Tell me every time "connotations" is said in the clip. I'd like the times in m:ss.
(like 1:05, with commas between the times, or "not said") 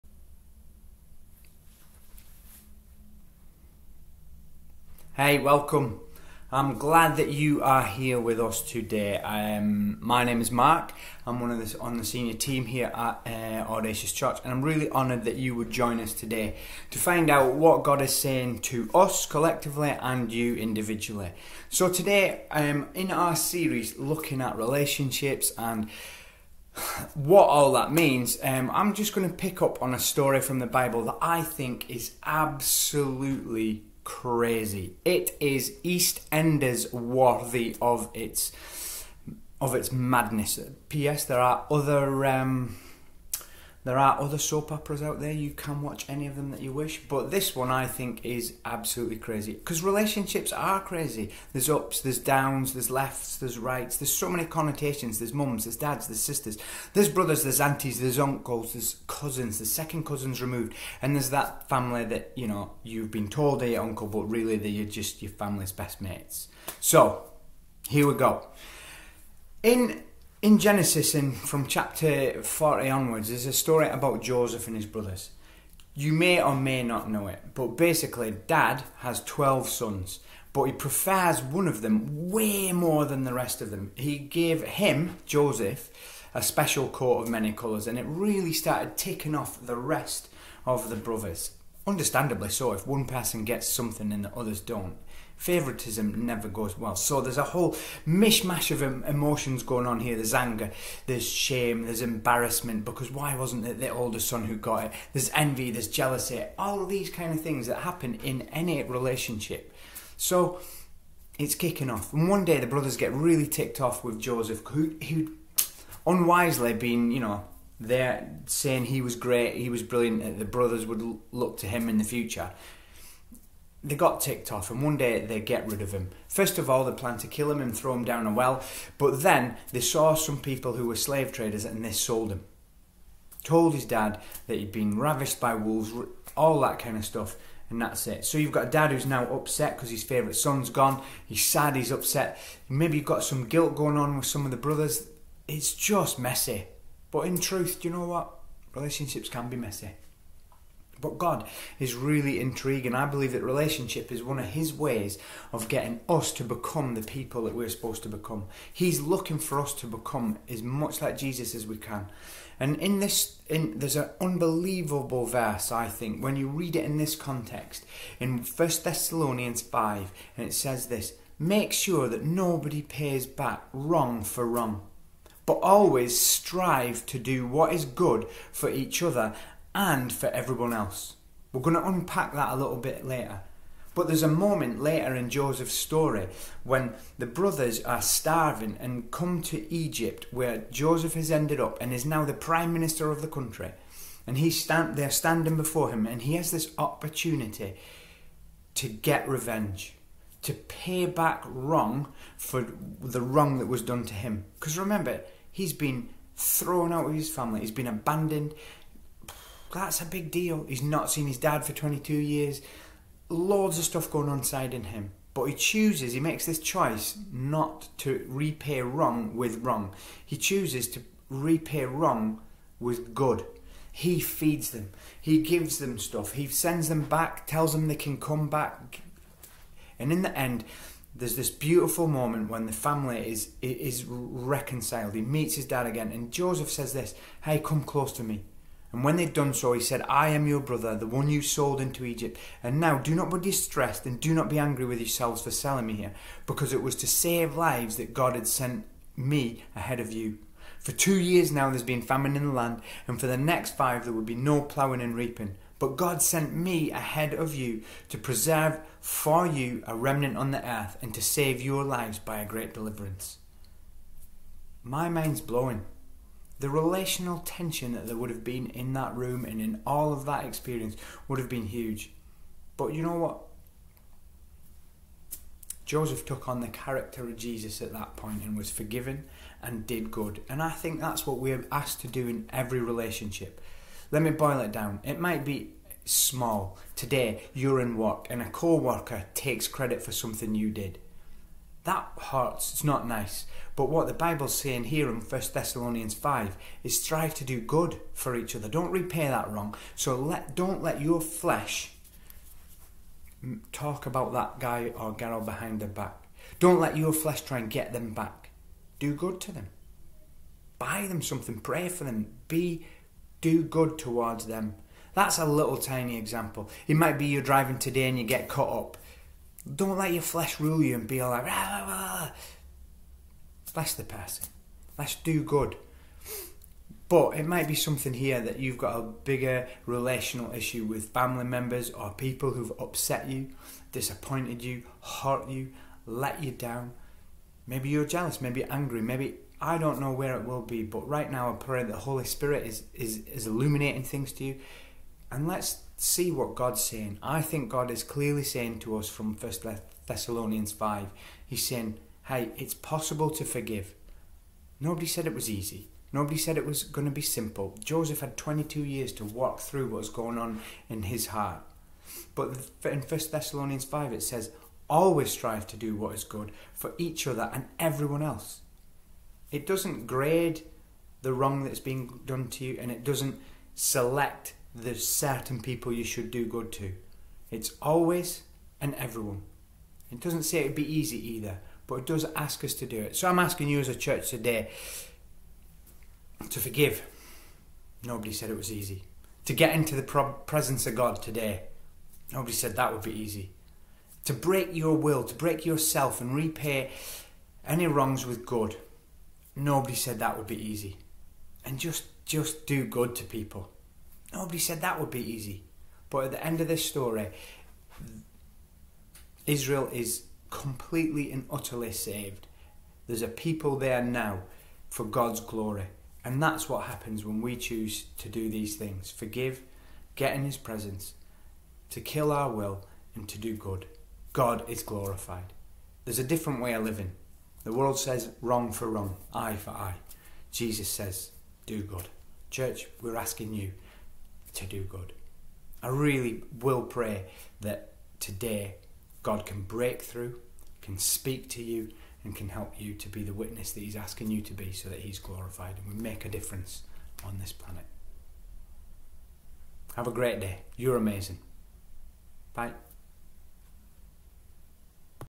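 0:54.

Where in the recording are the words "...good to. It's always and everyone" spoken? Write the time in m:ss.
6:16.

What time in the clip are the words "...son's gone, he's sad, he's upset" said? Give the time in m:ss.
2:20.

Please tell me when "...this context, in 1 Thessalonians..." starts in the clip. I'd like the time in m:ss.
2:46.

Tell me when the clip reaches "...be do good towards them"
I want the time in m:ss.
5:12.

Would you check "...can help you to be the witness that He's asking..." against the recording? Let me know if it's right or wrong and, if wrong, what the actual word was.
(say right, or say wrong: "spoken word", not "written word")
right.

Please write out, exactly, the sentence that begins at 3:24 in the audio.
Because remember, he's been thrown out of his family, he's been abandoned, that's a big deal.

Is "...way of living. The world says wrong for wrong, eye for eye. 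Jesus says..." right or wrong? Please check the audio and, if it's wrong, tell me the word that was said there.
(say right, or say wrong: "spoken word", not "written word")
right.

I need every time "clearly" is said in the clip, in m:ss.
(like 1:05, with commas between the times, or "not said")
5:48.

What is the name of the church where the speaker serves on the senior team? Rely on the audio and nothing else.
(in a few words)
Audacious Church.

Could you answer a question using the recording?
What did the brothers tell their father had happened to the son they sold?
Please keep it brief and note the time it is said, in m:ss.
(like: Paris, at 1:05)
Ravished by wolves, at 2:14.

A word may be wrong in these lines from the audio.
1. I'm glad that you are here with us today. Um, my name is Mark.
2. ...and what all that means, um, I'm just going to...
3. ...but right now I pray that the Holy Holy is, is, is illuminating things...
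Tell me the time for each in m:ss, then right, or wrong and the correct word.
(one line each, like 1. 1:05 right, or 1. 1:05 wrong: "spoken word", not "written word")
1. 0:06 right
2. 0:25 right
3. 5:40 wrong: "Spirit", not "Holy".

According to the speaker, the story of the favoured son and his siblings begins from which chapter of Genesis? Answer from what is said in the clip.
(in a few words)
40.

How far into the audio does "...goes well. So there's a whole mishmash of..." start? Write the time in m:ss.
1:36.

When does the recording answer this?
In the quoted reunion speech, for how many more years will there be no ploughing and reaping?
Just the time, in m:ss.
4:13.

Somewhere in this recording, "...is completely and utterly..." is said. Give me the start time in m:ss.
6:49.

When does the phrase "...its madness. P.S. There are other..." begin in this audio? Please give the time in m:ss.
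0:39.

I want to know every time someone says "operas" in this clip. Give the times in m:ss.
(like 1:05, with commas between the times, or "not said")
0:44.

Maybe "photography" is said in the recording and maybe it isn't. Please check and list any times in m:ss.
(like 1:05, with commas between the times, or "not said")
not said.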